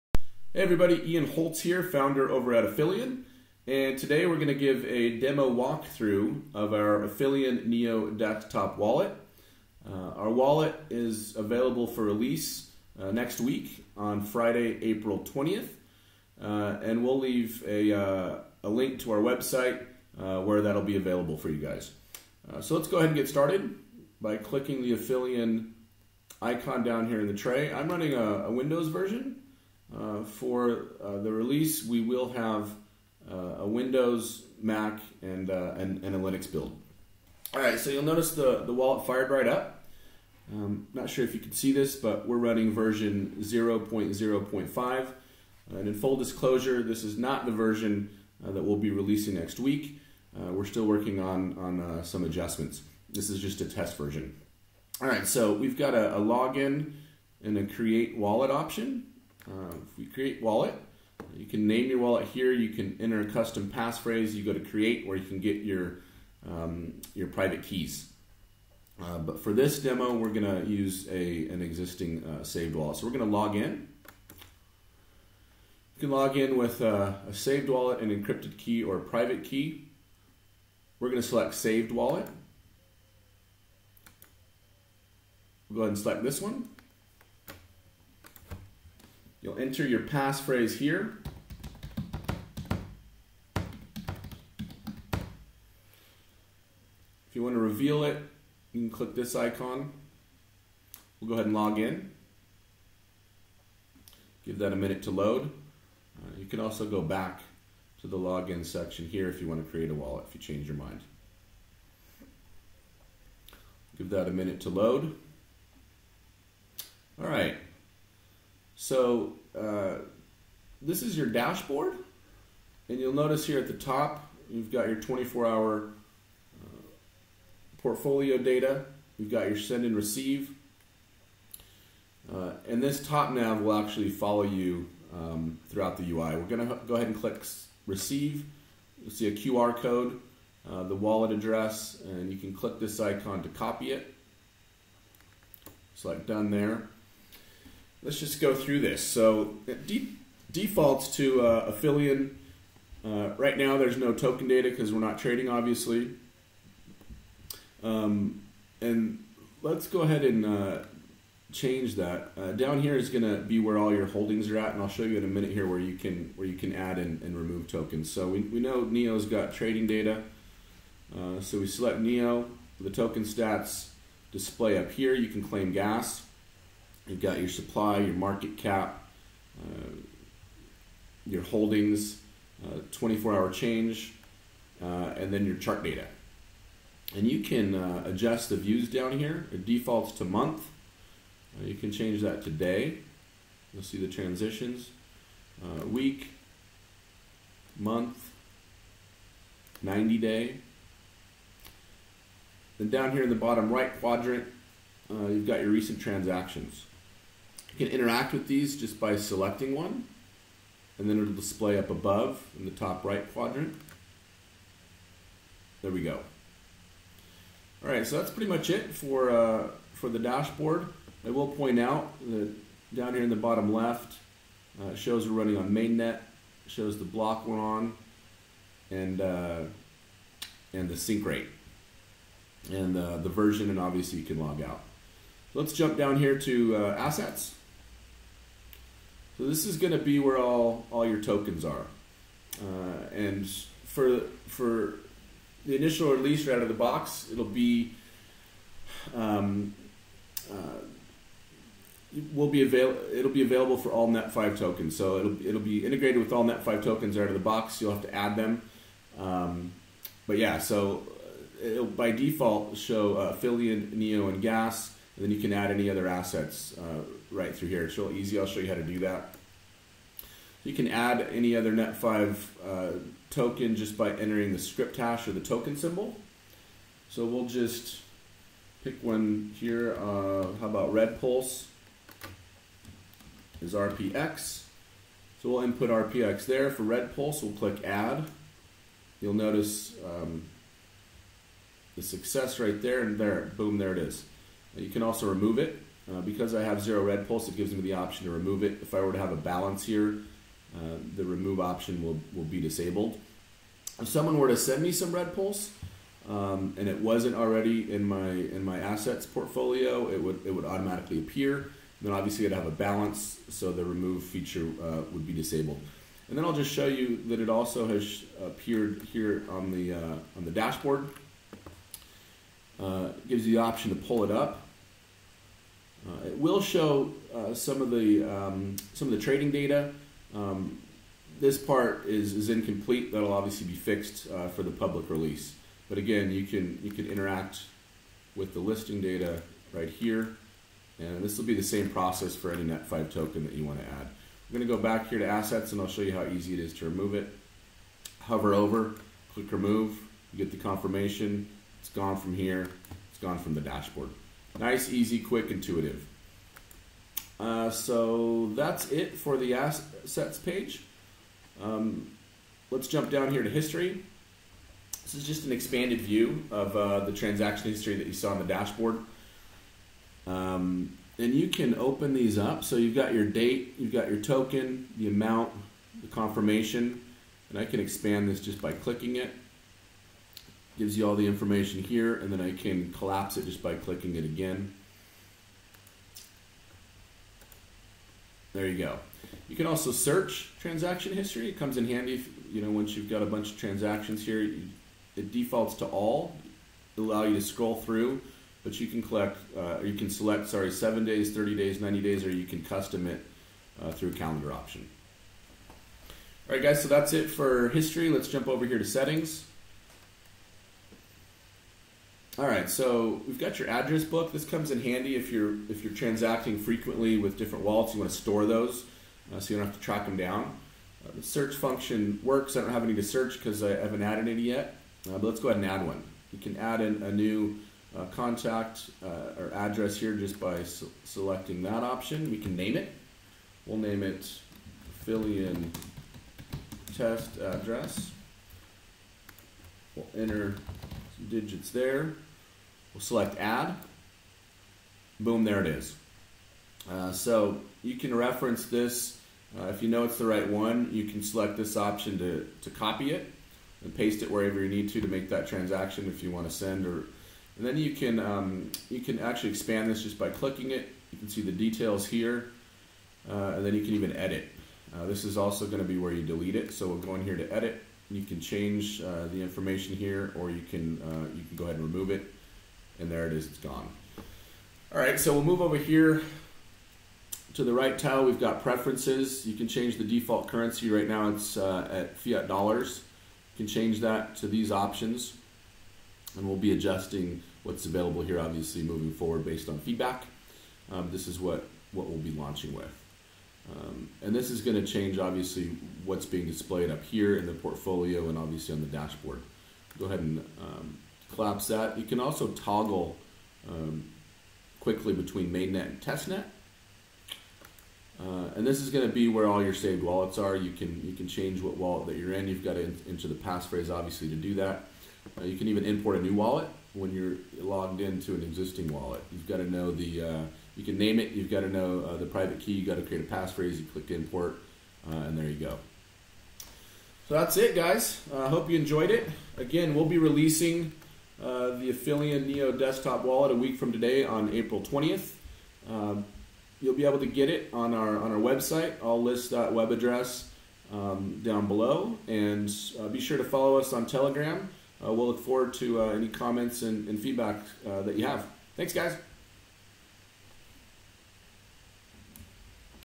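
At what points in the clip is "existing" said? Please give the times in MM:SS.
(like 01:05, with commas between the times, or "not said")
01:11, 08:38.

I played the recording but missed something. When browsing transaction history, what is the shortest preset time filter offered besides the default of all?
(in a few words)
Seven days.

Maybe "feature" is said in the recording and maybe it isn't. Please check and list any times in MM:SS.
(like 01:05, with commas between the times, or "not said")
05:14.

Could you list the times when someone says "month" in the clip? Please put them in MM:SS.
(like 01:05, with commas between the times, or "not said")
03:10, 03:17.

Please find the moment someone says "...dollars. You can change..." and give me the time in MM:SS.
08:02.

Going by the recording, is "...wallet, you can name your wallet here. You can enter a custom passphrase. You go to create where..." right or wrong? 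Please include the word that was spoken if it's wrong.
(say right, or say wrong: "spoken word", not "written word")
right.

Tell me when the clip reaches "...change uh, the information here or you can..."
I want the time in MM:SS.
07:48.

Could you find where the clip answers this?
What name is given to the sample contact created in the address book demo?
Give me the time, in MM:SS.
07:15.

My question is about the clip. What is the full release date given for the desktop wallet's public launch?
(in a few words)
Friday, April 20th.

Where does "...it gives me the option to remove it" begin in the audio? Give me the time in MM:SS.
04:57.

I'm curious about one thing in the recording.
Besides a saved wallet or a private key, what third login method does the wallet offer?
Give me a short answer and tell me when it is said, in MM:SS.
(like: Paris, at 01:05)
Encrypted key, at 01:18.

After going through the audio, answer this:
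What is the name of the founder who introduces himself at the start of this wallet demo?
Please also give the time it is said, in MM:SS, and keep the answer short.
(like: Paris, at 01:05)
Ian Holtz, at 00:01.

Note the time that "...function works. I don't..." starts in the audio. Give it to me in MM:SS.
07:01.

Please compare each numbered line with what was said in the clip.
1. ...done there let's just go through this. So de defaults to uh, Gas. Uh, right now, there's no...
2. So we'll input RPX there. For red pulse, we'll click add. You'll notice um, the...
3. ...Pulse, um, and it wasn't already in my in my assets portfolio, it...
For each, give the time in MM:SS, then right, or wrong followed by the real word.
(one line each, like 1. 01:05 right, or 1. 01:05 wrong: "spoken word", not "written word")
1. 02:26 wrong: "Aphelion", not "Gas"
2. 04:45 right
3. 05:05 right.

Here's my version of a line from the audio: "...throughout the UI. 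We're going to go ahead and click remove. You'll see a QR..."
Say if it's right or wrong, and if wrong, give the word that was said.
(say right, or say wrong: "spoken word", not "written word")
wrong: "receive", not "remove".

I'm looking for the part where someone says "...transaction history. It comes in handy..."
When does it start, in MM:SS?
06:30.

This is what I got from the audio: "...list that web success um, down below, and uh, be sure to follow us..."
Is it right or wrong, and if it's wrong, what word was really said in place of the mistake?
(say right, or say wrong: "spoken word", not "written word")
wrong: "address", not "success".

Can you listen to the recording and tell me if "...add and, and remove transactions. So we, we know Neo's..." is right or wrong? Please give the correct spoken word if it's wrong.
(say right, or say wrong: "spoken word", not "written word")
wrong: "tokens", not "transactions".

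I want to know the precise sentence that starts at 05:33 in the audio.
That'll obviously be fixed uh, for the public release.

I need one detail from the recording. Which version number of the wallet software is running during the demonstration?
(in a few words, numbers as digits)
0.0.5.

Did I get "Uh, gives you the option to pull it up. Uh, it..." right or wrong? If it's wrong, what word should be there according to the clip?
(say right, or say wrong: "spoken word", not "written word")
right.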